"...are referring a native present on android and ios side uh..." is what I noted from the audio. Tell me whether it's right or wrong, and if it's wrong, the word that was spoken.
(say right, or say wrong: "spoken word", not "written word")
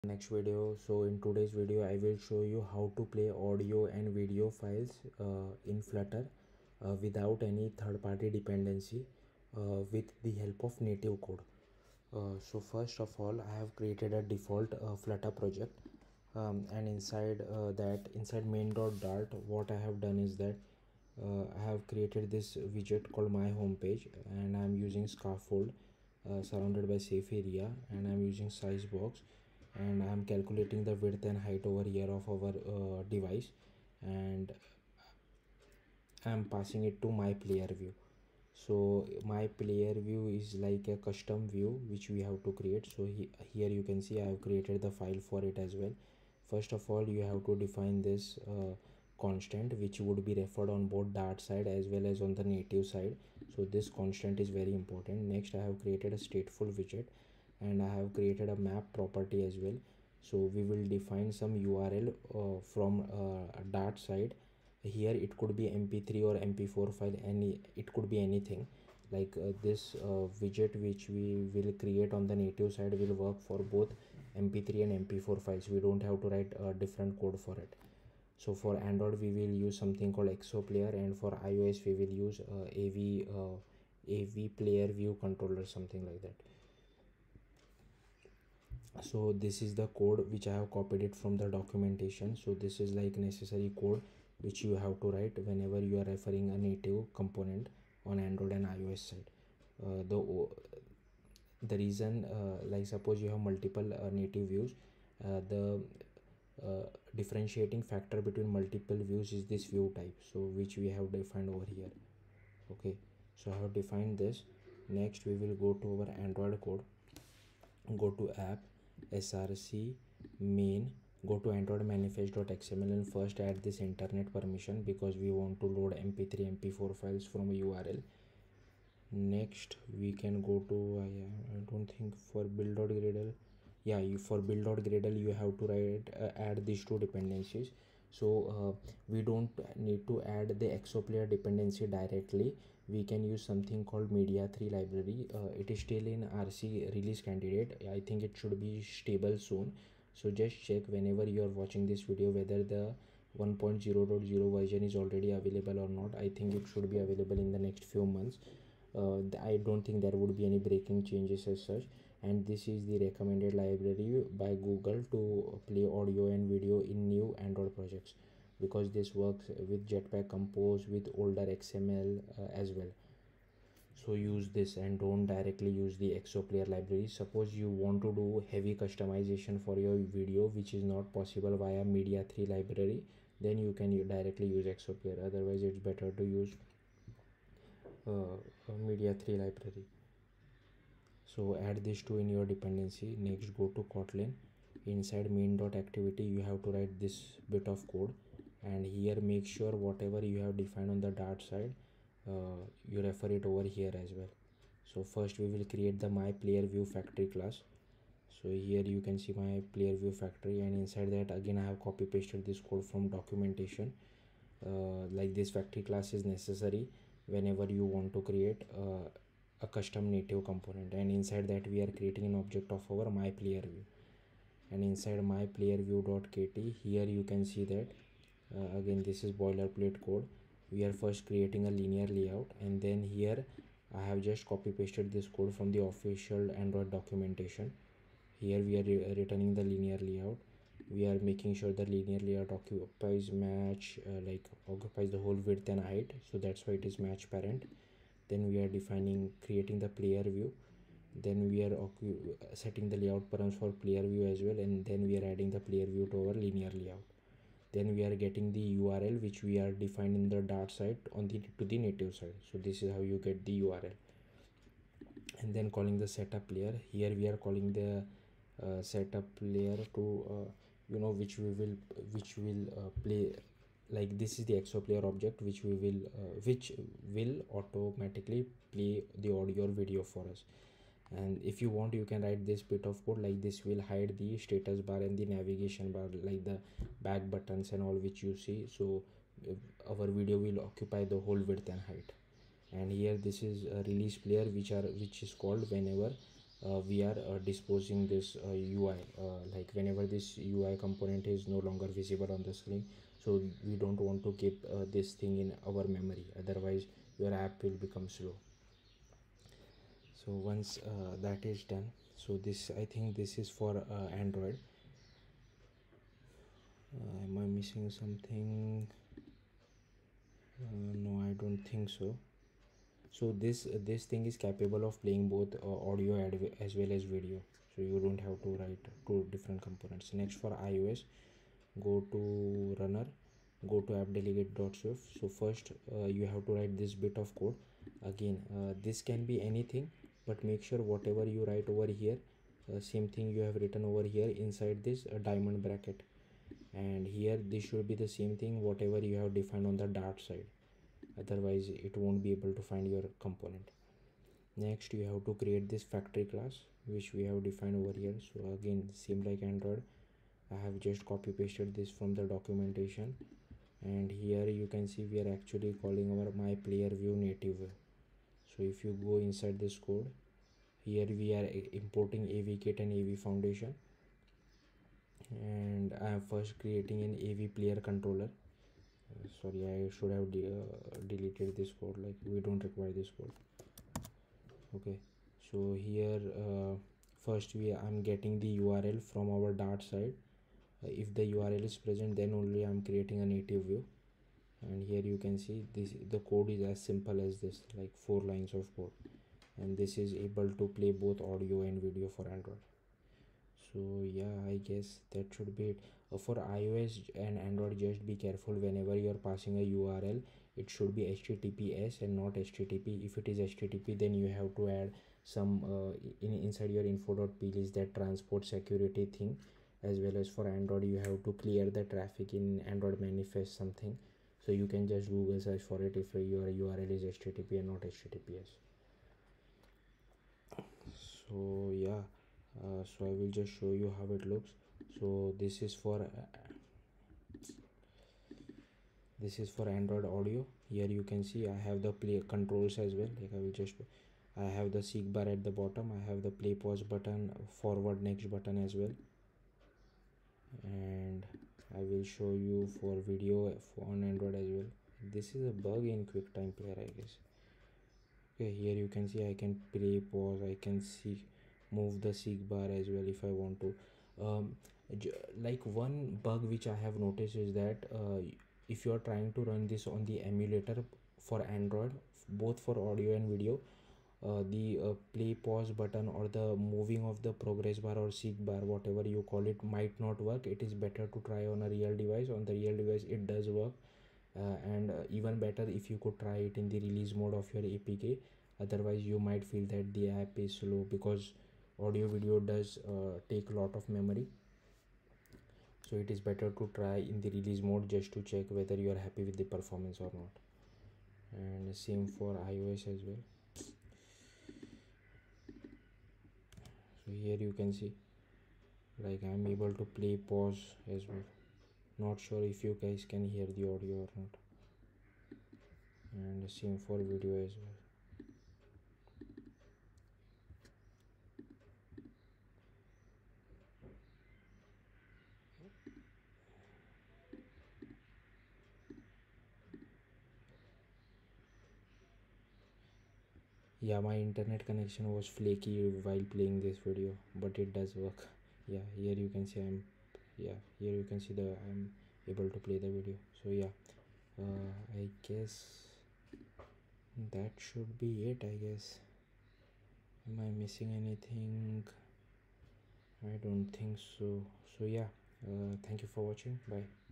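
wrong: "component", not "present".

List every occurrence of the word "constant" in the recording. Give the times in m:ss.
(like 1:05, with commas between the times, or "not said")
0:49, 0:53.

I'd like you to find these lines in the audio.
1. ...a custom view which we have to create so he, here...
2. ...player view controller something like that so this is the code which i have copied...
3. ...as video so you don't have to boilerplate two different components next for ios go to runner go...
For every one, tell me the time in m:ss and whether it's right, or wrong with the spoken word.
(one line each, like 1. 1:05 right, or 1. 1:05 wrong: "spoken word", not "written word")
1. 0:40 right
2. 1:24 right
3. 5:26 wrong: "write", not "boilerplate".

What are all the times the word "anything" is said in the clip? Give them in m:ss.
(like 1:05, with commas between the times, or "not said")
1:08, 5:39, 9:10.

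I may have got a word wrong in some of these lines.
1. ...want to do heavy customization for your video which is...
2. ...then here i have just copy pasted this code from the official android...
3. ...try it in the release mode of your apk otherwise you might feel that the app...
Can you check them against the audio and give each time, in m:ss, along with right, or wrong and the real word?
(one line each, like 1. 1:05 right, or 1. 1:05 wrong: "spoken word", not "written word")
1. 2:57 right
2. 3:52 right
3. 8:06 right.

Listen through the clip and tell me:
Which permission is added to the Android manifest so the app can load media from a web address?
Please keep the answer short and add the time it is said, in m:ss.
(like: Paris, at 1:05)
Internet permission, at 2:03.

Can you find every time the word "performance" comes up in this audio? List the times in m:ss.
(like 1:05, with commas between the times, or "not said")
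8:19.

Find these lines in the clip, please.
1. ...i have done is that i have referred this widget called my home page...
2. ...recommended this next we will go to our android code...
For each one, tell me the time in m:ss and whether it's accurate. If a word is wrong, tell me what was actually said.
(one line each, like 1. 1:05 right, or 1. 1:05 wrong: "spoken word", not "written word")
1. 0:19 wrong: "created", not "referred"
2. 1:53 wrong: "defined", not "recommended".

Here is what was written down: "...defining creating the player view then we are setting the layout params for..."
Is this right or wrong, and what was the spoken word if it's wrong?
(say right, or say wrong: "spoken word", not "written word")
right.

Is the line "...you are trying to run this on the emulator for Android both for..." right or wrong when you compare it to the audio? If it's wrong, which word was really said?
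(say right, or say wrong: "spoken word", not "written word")
right.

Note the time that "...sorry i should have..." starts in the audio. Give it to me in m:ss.
6:19.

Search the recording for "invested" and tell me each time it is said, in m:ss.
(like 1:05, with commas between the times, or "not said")
not said.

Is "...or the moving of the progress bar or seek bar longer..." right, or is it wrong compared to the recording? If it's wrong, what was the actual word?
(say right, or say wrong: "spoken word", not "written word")
wrong: "whatever", not "longer".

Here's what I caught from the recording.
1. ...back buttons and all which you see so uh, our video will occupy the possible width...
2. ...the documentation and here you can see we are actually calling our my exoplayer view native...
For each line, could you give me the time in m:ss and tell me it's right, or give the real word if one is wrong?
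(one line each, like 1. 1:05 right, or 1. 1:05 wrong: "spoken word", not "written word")
1. 4:47 wrong: "whole", not "possible"
2. 6:02 wrong: "player", not "exoplayer".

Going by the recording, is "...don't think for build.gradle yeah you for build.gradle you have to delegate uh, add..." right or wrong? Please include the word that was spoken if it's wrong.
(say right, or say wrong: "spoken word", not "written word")
wrong: "write", not "delegate".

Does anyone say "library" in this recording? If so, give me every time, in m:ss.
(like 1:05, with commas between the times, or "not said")
2:24, 2:43, 2:56, 3:02, 3:09.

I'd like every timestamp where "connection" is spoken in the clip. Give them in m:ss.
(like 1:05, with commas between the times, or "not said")
8:54.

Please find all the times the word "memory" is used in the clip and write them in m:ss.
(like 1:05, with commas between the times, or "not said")
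5:05, 8:13.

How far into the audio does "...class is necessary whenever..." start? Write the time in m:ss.
3:35.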